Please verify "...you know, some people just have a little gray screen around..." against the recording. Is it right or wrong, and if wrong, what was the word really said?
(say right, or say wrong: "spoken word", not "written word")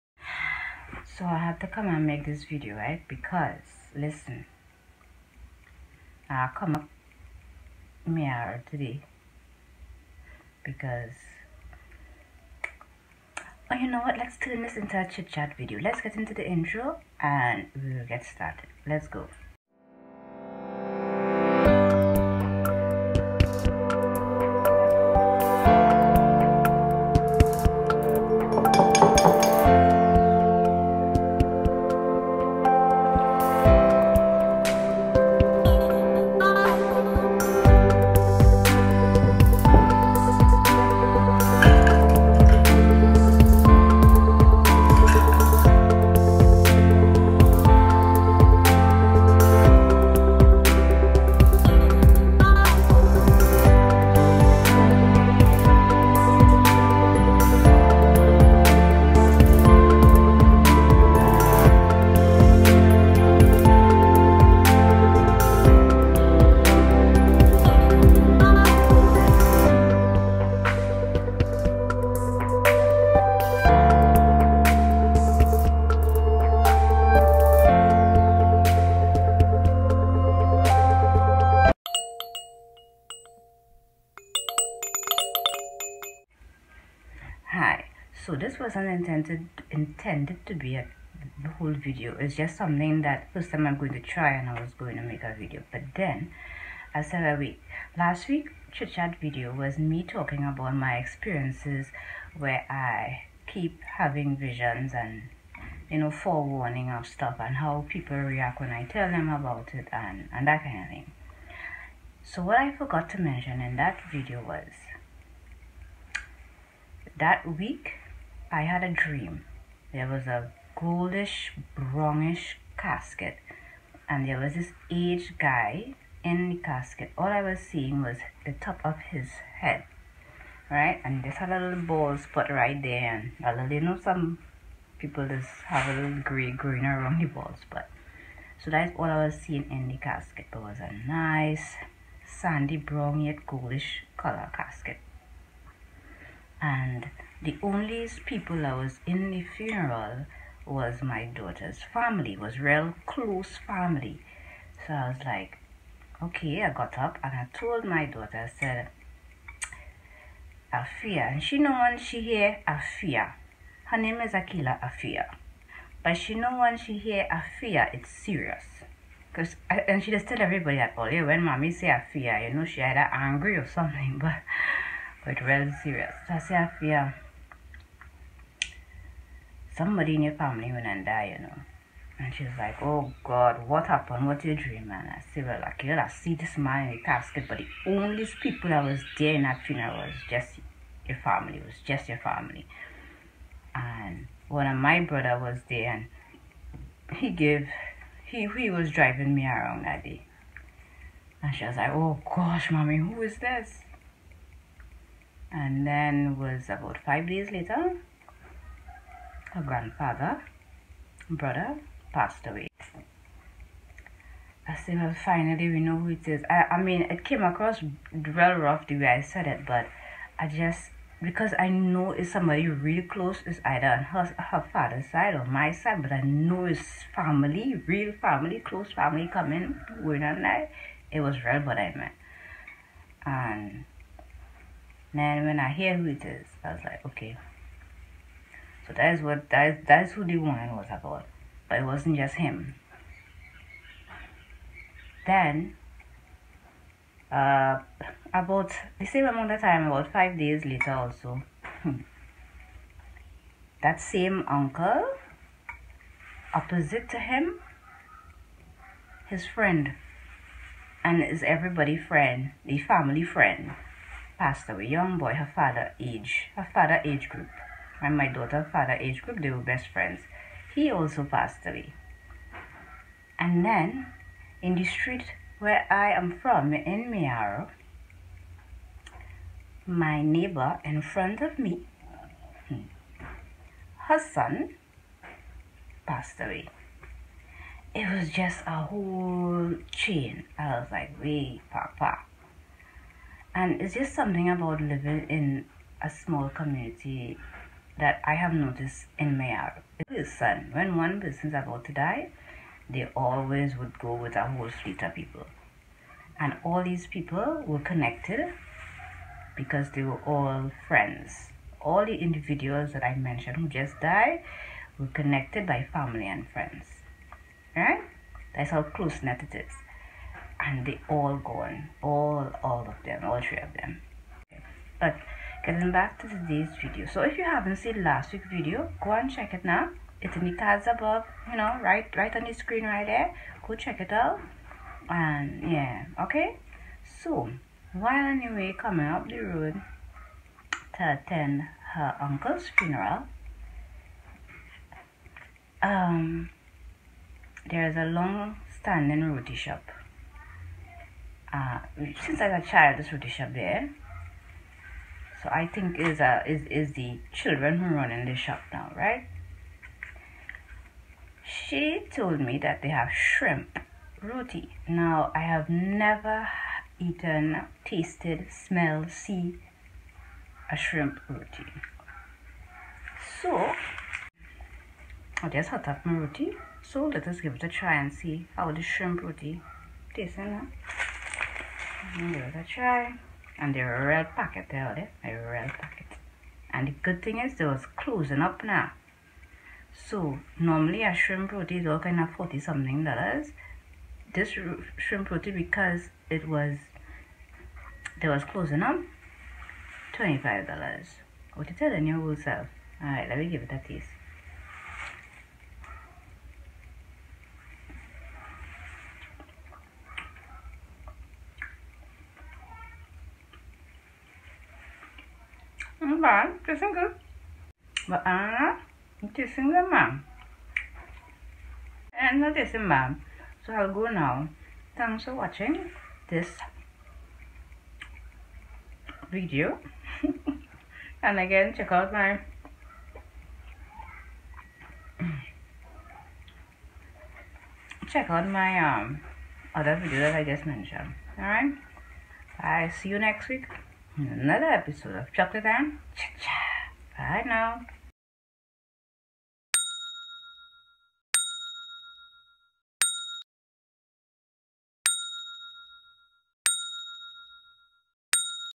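wrong: "green", not "screen".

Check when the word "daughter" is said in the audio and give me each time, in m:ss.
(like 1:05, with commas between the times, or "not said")
2:31, 2:38, 4:28.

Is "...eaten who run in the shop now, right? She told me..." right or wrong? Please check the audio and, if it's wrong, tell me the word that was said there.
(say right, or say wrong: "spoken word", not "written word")
wrong: "children", not "eaten".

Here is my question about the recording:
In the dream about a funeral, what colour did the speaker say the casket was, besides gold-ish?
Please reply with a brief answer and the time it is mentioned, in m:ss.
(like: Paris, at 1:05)
Sandy brown, at 2:22.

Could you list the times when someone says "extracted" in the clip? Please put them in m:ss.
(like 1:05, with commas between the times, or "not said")
not said.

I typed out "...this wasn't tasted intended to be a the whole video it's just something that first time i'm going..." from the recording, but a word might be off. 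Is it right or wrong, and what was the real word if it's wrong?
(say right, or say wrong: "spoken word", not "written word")
wrong: "intended", not "tasted".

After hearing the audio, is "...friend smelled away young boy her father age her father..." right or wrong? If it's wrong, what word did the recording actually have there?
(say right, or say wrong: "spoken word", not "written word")
wrong: "passed", not "smelled".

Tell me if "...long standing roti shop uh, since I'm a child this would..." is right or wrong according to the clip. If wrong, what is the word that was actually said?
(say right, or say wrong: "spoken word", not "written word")
right.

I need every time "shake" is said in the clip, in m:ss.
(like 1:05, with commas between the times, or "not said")
not said.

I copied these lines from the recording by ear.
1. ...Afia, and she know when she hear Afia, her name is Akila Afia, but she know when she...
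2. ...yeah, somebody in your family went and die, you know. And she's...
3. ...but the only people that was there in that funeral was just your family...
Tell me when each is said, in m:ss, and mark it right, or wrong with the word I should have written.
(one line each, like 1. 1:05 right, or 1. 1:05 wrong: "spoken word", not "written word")
1. 2:40 right
2. 2:56 right
3. 3:07 right.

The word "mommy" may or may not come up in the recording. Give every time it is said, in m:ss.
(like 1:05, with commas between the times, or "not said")
2:51, 3:22.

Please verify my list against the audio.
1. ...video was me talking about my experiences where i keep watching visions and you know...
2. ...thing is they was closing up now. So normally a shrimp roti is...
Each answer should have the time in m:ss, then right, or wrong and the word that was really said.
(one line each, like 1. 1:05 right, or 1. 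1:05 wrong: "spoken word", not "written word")
1. 1:39 wrong: "having", not "watching"
2. 6:27 right.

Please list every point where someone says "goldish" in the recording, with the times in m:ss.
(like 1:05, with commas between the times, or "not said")
2:00, 2:23.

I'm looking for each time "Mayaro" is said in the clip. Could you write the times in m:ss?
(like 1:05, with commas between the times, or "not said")
4:37, 4:59.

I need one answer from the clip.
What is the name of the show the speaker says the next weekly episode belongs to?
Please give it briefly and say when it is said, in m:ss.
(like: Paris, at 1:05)
Chocolate and Cha-Cha, at 7:25.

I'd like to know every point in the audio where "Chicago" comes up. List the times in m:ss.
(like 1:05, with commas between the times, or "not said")
not said.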